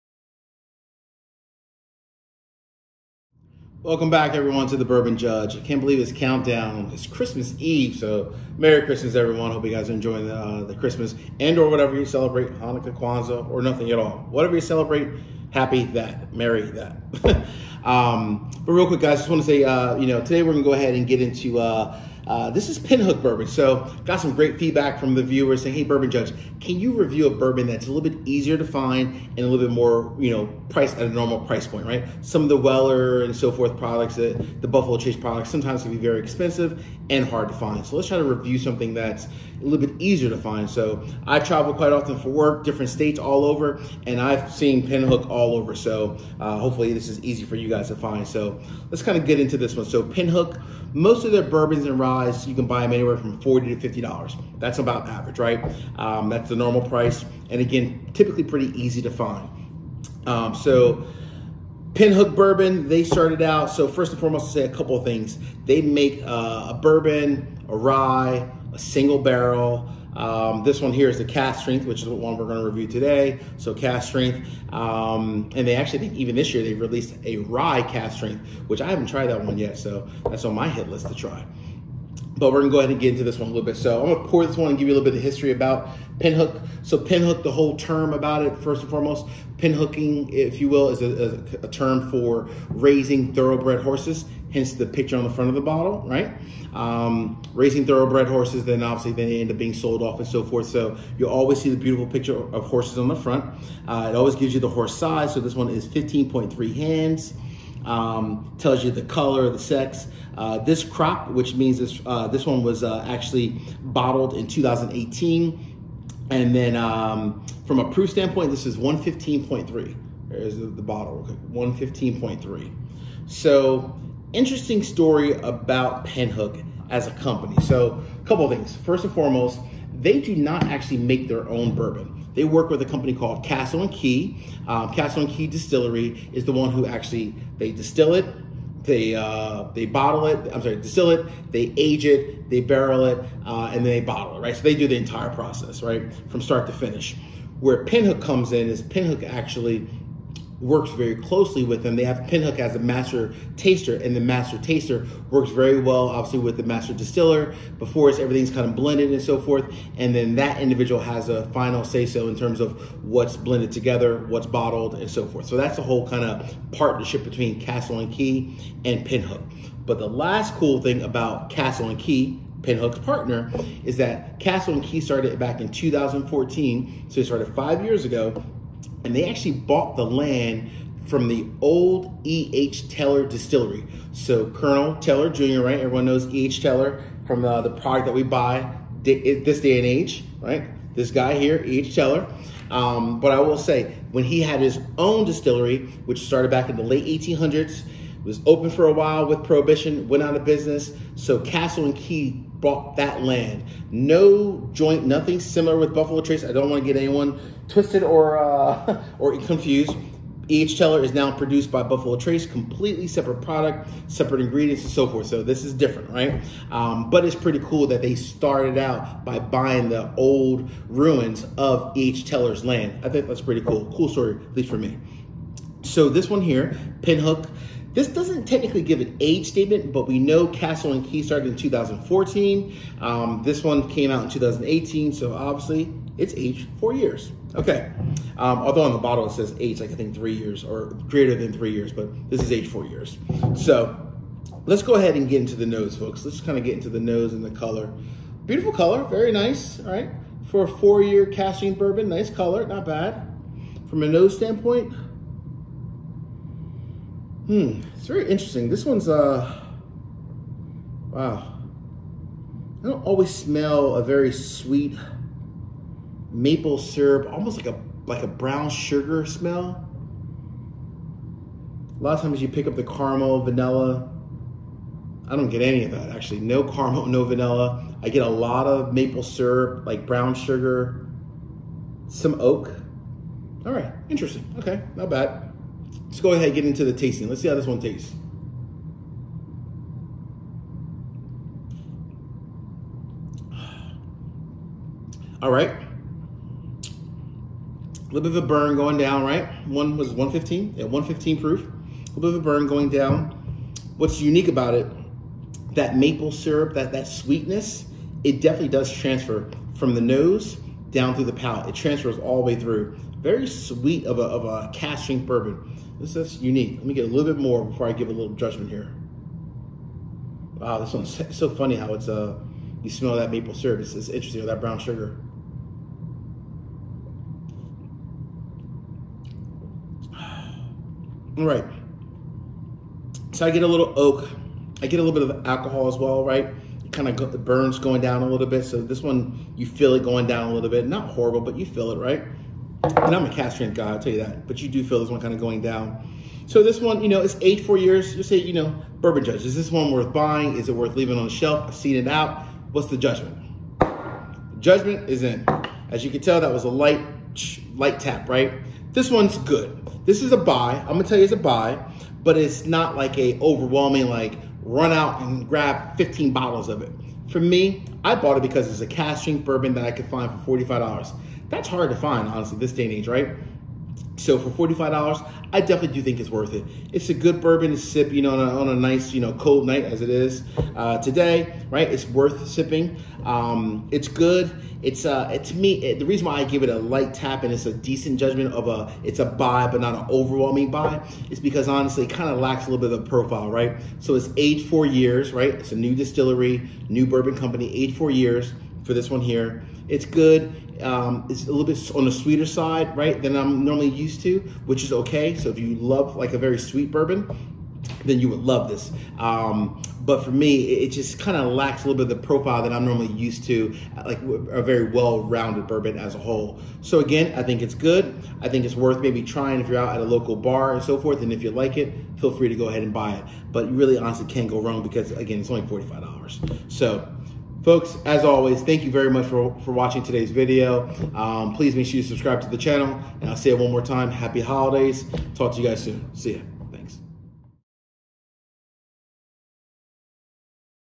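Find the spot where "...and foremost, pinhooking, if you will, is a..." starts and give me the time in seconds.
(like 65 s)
88 s.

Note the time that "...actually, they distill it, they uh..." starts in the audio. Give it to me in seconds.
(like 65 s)
136 s.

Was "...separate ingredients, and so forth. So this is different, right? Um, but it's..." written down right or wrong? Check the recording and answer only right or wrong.
right.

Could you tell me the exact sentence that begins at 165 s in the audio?
So that's the whole kind of partnership between Castle and Key and Pinhook.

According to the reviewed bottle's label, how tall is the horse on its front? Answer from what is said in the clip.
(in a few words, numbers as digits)
15.3 hands.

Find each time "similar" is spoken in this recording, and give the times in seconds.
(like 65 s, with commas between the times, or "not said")
205 s.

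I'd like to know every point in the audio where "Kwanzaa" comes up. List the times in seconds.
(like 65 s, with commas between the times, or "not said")
12 s.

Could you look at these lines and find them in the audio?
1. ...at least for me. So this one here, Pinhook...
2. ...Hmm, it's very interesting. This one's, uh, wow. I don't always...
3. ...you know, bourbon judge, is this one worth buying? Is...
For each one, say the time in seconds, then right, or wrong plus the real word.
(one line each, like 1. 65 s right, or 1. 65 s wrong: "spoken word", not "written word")
1. 224 s right
2. 257 s right
3. 348 s right.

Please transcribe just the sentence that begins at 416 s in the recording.
So again, I think it's good.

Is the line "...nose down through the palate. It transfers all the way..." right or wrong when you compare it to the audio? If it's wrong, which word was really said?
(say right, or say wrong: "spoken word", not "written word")
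right.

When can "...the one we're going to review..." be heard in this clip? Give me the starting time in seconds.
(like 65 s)
72 s.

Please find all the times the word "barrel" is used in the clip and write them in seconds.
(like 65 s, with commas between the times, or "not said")
69 s, 142 s.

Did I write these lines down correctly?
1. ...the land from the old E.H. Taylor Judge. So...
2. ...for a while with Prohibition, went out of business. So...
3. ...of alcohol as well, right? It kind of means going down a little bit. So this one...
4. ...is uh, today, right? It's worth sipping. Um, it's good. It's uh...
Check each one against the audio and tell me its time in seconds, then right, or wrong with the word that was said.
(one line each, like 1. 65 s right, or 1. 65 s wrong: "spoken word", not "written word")
1. 179 s wrong: "Distillery", not "Judge"
2. 198 s right
3. 335 s wrong: "burns", not "means"
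4. 380 s right.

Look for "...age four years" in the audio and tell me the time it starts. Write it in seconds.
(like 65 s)
242 s.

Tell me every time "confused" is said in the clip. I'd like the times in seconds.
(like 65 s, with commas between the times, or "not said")
209 s.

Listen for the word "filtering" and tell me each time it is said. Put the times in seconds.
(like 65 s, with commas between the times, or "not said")
not said.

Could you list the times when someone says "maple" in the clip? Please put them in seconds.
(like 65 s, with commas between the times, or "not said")
266 s, 278 s, 305 s, 323 s.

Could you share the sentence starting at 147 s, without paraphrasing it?
Where Pinhook comes in is Pinhook actually works very closely with them.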